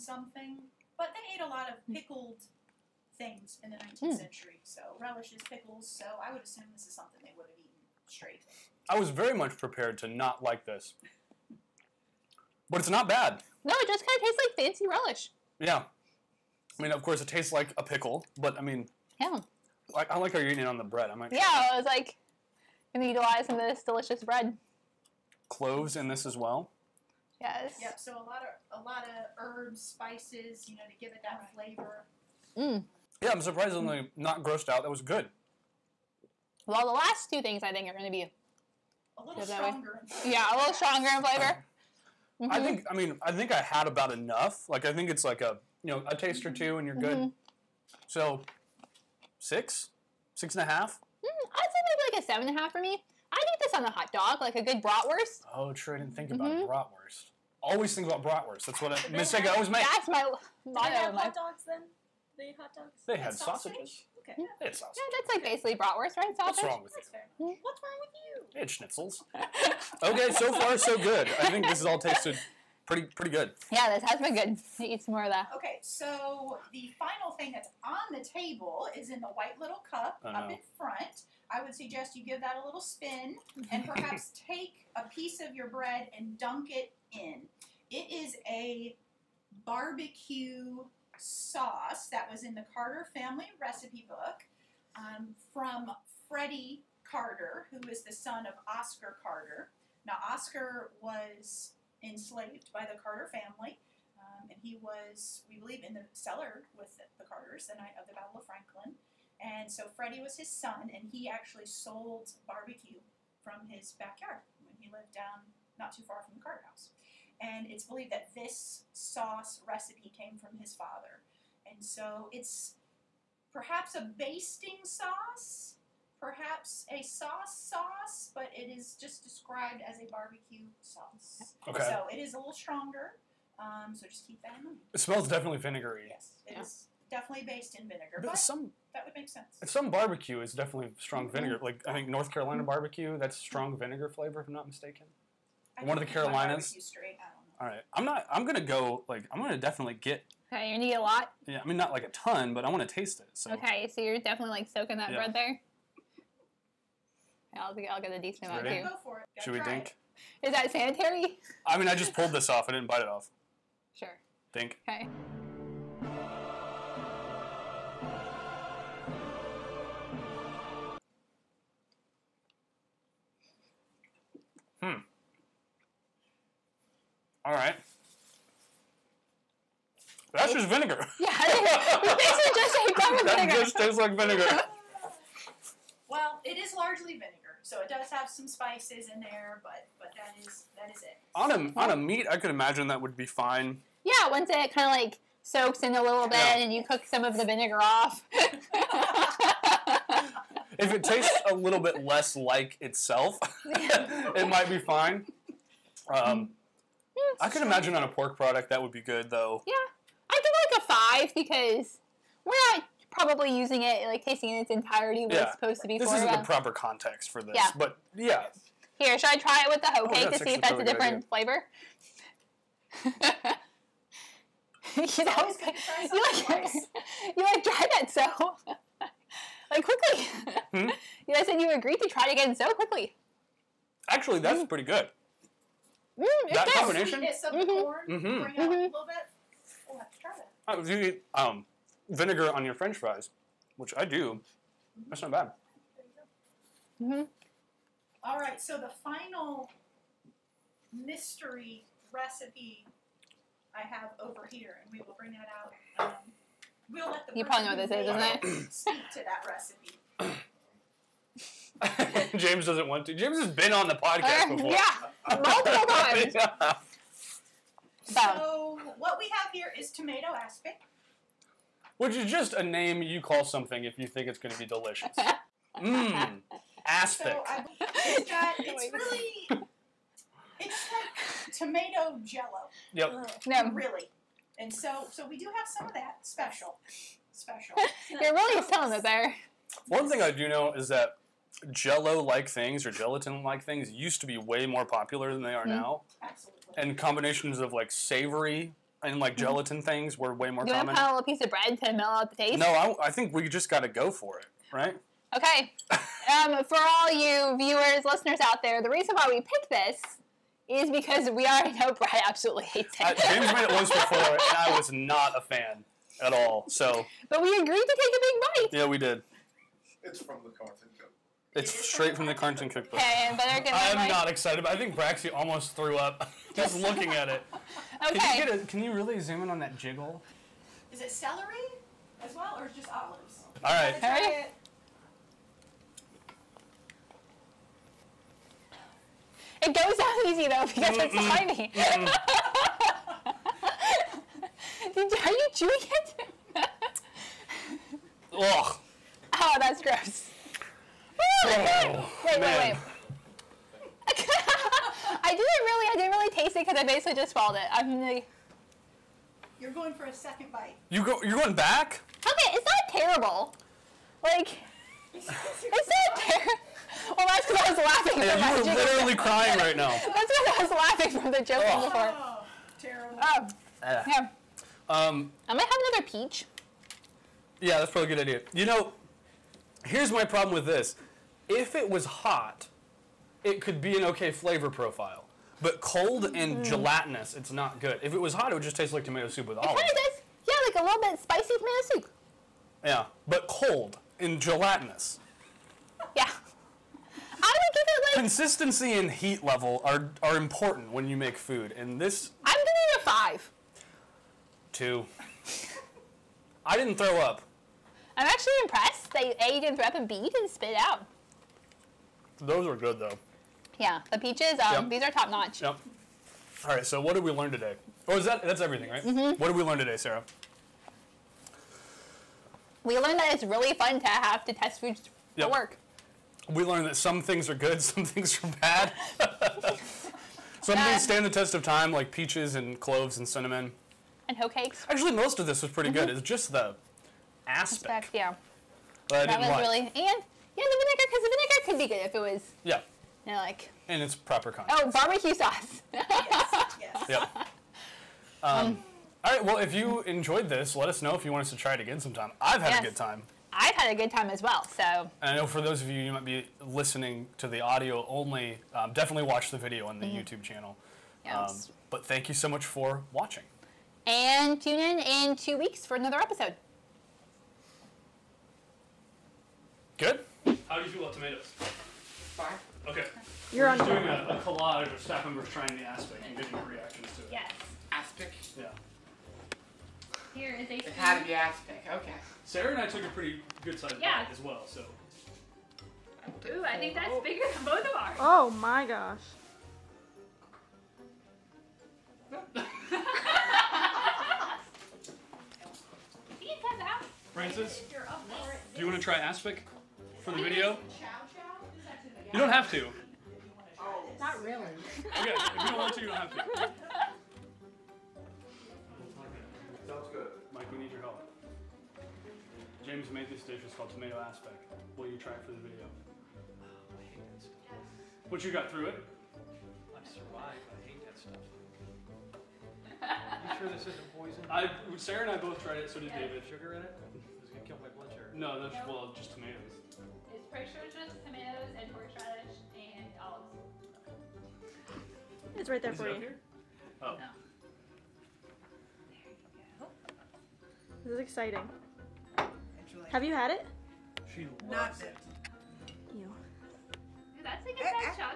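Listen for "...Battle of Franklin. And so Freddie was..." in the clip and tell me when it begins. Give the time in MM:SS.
01:48.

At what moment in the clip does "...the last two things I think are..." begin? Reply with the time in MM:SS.
00:36.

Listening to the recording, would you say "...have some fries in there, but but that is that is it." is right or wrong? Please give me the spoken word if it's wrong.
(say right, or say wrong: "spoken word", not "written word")
wrong: "spices", not "fries".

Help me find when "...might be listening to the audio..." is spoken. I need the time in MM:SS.
07:36.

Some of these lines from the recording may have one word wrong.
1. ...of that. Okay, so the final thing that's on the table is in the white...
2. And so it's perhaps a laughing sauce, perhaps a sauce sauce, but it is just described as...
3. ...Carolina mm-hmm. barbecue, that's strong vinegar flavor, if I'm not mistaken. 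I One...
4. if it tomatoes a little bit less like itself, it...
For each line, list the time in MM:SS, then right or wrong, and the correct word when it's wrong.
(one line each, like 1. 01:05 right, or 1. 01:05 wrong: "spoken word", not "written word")
1. 01:15 right
2. 02:01 wrong: "basting", not "laughing"
3. 02:22 right
4. 03:20 wrong: "tastes", not "tomatoes".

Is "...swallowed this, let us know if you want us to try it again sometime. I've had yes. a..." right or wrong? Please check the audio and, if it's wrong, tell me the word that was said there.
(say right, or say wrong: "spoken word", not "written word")
wrong: "enjoyed", not "swallowed".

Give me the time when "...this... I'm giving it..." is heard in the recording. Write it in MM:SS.
06:42.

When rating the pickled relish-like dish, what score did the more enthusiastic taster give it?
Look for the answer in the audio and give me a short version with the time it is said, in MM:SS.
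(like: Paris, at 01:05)
7.5, at 00:52.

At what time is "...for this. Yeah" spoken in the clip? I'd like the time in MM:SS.
03:37.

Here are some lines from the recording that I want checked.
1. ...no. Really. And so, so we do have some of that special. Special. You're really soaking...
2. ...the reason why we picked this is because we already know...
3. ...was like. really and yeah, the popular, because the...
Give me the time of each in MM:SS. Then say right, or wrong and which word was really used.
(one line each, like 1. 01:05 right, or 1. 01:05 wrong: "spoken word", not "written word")
1. 04:43 wrong: "selling", not "soaking"
2. 05:08 right
3. 07:19 wrong: "vinegar", not "popular".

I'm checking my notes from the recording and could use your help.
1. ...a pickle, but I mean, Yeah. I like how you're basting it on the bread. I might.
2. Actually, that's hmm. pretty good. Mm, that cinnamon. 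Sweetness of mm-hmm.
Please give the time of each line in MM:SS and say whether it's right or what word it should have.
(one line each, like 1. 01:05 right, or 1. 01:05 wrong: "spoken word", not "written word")
1. 00:17 wrong: "eating", not "basting"
2. 03:54 wrong: "combination", not "cinnamon".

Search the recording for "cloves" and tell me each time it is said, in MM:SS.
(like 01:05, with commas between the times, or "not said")
00:25, 07:12.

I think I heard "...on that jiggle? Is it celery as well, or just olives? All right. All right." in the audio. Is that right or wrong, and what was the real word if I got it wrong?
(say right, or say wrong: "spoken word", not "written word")
right.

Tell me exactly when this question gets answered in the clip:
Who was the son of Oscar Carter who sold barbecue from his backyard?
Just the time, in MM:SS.
01:36.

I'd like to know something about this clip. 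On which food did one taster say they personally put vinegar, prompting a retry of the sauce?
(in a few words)
French fries.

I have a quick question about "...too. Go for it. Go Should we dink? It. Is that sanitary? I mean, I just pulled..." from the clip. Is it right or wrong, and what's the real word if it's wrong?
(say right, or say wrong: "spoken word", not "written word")
right.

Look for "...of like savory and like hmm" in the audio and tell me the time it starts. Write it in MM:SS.
04:57.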